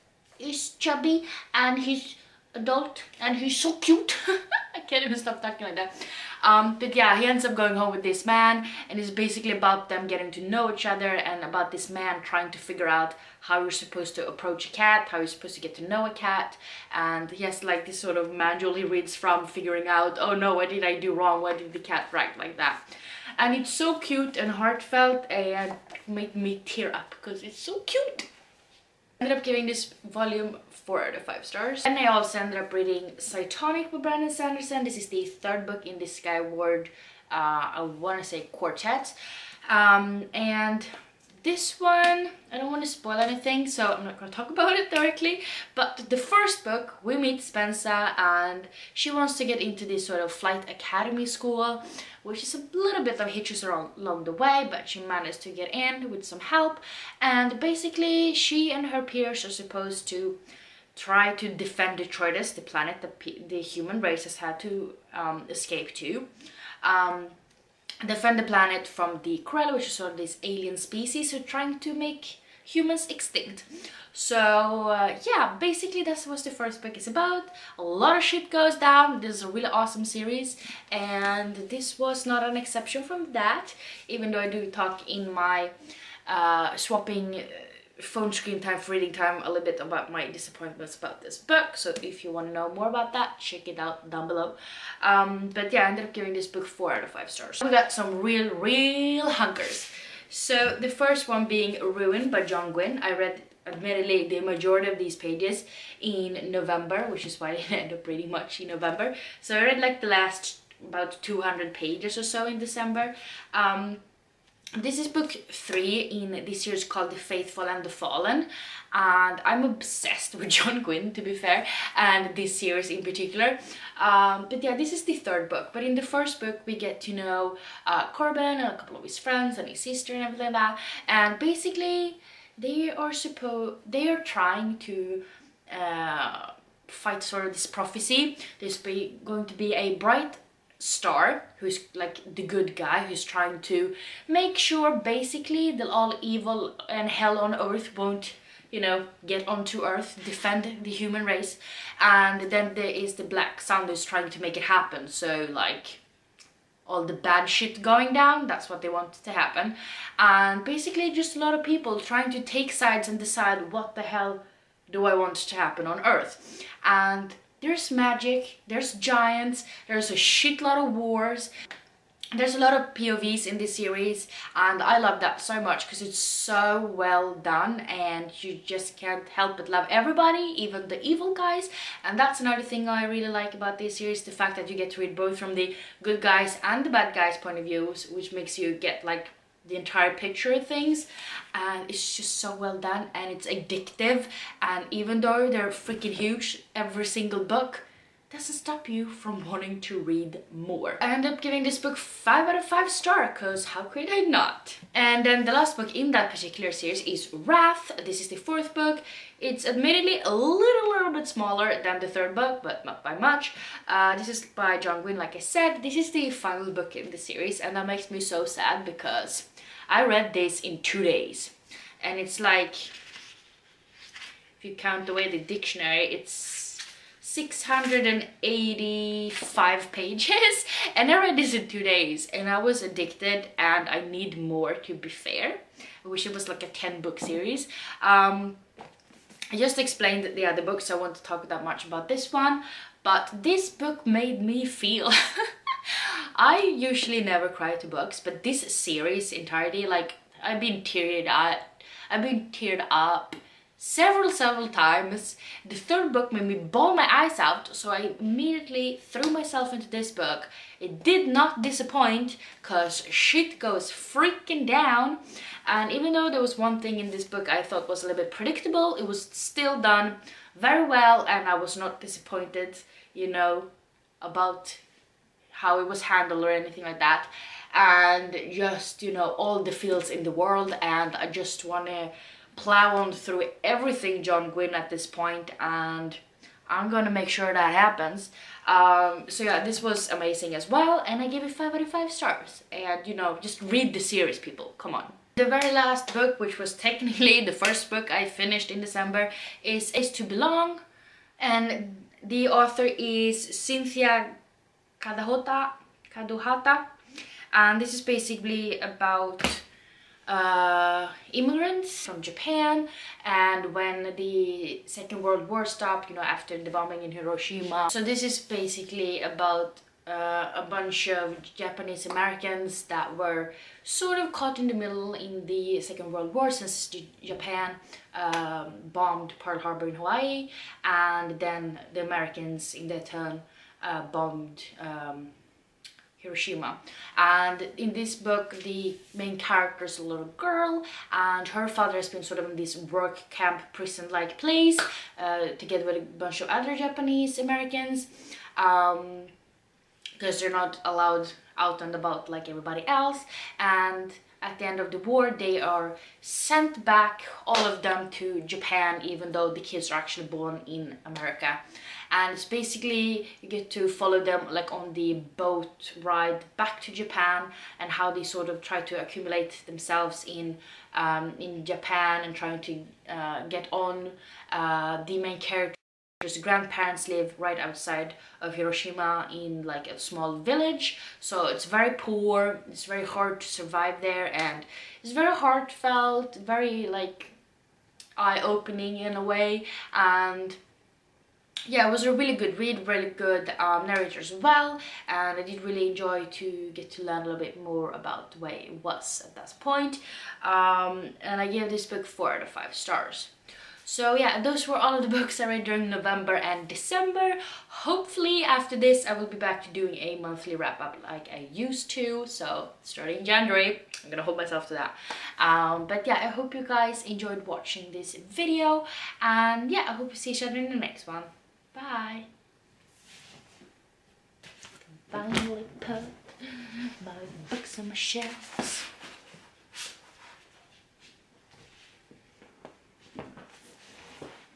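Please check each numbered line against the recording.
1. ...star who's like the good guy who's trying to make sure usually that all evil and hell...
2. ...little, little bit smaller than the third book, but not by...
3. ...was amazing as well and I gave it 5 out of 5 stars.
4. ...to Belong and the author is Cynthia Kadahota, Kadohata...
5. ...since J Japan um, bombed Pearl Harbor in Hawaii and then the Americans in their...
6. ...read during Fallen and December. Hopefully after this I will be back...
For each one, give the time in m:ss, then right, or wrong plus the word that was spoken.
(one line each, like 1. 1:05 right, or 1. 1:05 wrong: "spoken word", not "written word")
1. 2:20 wrong: "basically", not "usually"
2. 3:30 right
3. 4:49 right
4. 5:00 right
5. 5:26 right
6. 6:45 wrong: "November", not "Fallen".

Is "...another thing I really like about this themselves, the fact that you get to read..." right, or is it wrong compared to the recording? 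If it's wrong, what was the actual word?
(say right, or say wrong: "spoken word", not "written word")
wrong: "series", not "themselves".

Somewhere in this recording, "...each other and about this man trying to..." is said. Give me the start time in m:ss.
0:10.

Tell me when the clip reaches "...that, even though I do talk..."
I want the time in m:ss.
1:23.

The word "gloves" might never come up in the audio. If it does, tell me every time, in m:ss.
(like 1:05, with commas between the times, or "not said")
not said.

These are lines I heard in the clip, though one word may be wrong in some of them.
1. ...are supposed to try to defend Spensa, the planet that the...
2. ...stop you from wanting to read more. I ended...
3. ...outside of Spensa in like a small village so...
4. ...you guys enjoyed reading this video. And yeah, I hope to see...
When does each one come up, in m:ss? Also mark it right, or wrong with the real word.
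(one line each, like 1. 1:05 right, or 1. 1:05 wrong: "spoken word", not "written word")
1. 0:59 wrong: "Detritus", not "Spensa"
2. 3:18 right
3. 6:17 wrong: "Hiroshima", not "Spensa"
4. 6:56 wrong: "watching", not "reading".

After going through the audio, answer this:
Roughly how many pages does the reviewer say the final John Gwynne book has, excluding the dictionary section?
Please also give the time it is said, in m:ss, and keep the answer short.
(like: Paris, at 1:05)
685, at 3:47.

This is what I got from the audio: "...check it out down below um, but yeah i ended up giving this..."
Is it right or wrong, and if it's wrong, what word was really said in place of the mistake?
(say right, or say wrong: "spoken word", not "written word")
right.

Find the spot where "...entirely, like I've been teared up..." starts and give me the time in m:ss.
4:09.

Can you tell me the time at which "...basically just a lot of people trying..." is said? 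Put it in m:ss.
2:40.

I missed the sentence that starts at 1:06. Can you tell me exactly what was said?
Um, defend the planet from the Krell, which is sort of this alien species who are trying to make humans extinct.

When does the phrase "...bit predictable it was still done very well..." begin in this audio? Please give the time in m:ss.
4:28.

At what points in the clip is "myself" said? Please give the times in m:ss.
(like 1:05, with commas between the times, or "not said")
4:19, 6:54.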